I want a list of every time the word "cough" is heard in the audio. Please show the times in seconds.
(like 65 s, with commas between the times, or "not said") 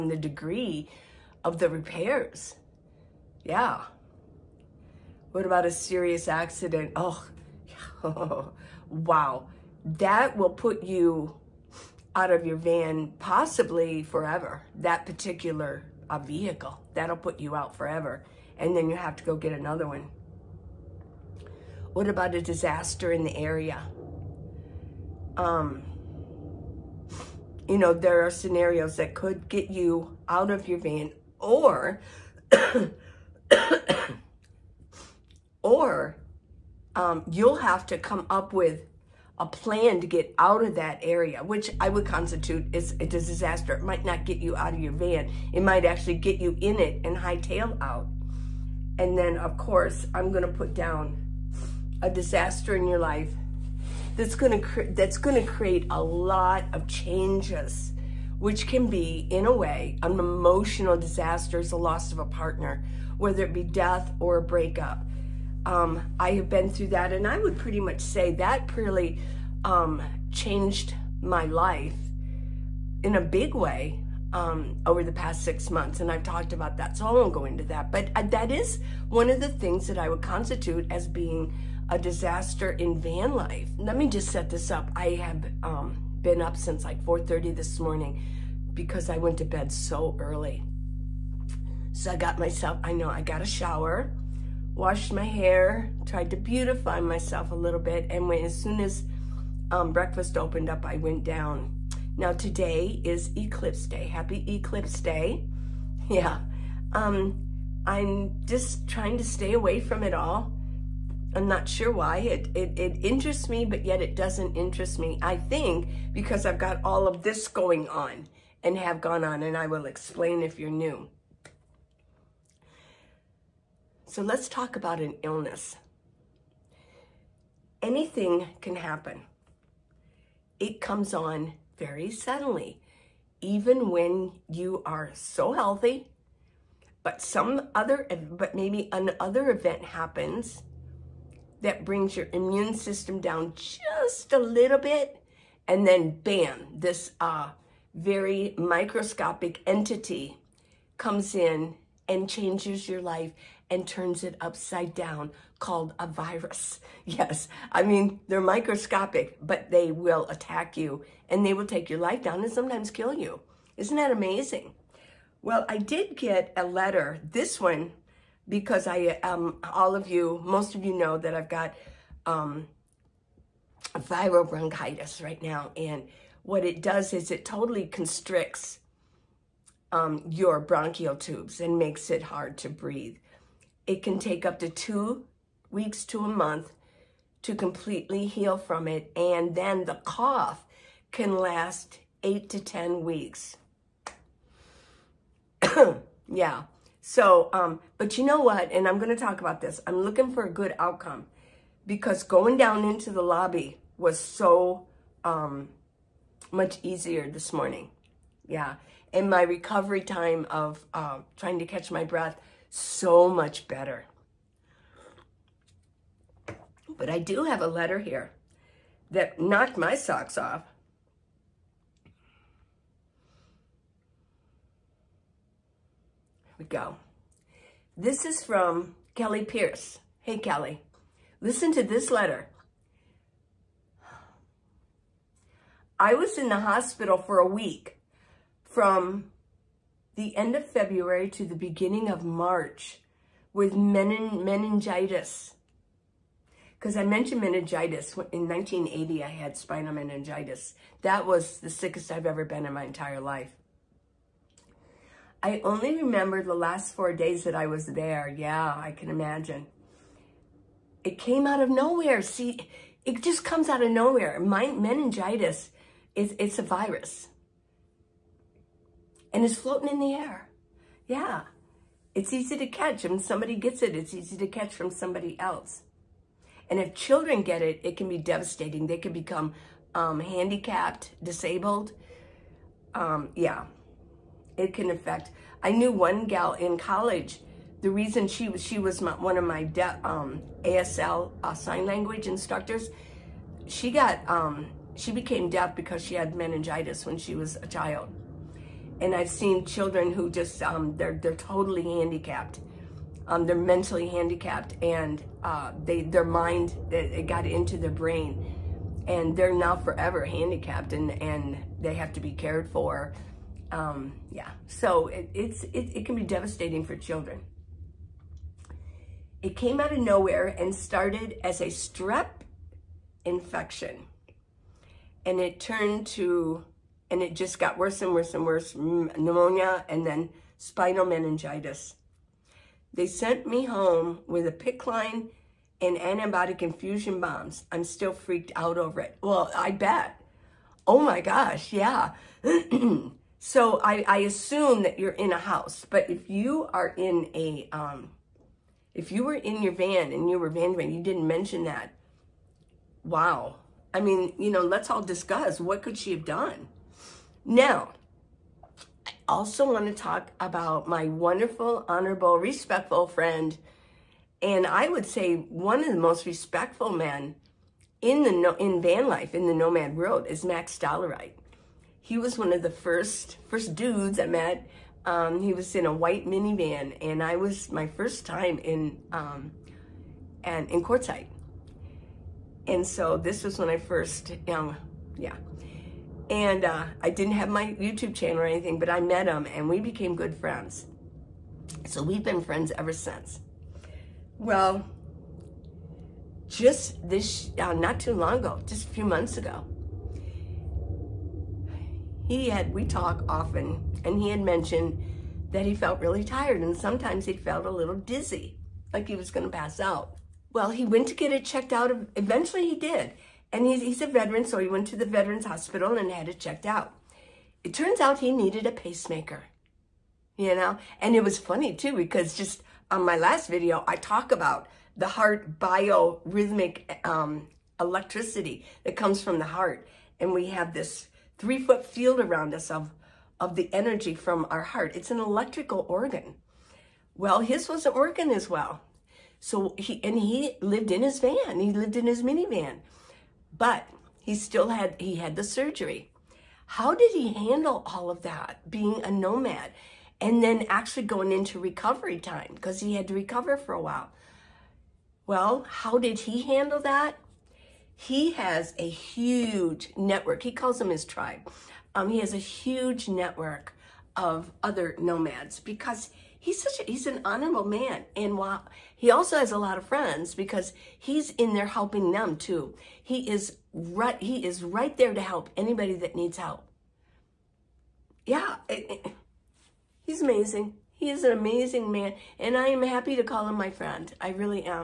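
190 s.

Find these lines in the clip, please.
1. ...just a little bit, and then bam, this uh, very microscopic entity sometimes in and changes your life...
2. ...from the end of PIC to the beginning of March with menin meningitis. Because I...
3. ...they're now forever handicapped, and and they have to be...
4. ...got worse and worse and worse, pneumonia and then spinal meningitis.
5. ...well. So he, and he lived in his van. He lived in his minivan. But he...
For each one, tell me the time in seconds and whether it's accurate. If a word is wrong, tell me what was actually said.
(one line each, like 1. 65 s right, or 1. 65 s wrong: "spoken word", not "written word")
1. 143 s wrong: "comes", not "sometimes"
2. 238 s wrong: "February", not "PIC"
3. 309 s right
4. 327 s right
5. 438 s right.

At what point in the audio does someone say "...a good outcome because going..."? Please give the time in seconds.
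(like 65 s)
200 s.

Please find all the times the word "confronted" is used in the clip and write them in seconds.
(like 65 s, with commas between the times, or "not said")
not said.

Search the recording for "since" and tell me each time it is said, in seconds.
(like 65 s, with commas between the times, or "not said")
86 s, 392 s.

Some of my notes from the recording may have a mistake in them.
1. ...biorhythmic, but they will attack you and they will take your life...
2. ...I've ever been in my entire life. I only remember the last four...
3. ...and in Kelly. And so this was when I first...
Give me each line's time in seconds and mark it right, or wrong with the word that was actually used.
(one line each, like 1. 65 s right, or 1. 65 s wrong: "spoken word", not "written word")
1. 158 s wrong: "microscopic", not "biorhythmic"
2. 252 s right
3. 380 s wrong: "Quartzsite", not "Kelly".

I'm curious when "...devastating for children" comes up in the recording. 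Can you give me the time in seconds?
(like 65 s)
316 s.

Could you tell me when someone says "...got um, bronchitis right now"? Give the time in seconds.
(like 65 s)
171 s.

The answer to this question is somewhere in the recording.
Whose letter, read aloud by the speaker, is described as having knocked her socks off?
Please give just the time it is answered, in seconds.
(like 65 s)
229 s.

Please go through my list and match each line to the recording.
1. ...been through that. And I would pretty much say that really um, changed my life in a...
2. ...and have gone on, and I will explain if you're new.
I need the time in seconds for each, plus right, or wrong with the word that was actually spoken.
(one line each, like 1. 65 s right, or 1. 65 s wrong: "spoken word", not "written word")
1. 66 s right
2. 118 s right.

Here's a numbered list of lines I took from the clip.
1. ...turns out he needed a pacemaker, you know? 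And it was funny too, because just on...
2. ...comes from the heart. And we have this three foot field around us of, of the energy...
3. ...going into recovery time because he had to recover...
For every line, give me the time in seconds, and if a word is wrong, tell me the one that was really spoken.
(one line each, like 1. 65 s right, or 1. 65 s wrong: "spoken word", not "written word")
1. 417 s right
2. 428 s right
3. 451 s right.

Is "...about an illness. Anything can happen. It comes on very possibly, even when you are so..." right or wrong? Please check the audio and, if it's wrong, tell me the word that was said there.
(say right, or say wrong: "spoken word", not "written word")
wrong: "suddenly", not "possibly".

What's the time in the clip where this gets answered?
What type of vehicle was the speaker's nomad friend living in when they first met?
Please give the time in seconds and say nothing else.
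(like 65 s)
375 s.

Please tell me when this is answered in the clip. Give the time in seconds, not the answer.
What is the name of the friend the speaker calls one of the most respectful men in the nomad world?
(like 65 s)
370 s.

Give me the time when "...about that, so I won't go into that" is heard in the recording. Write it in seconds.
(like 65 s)
76 s.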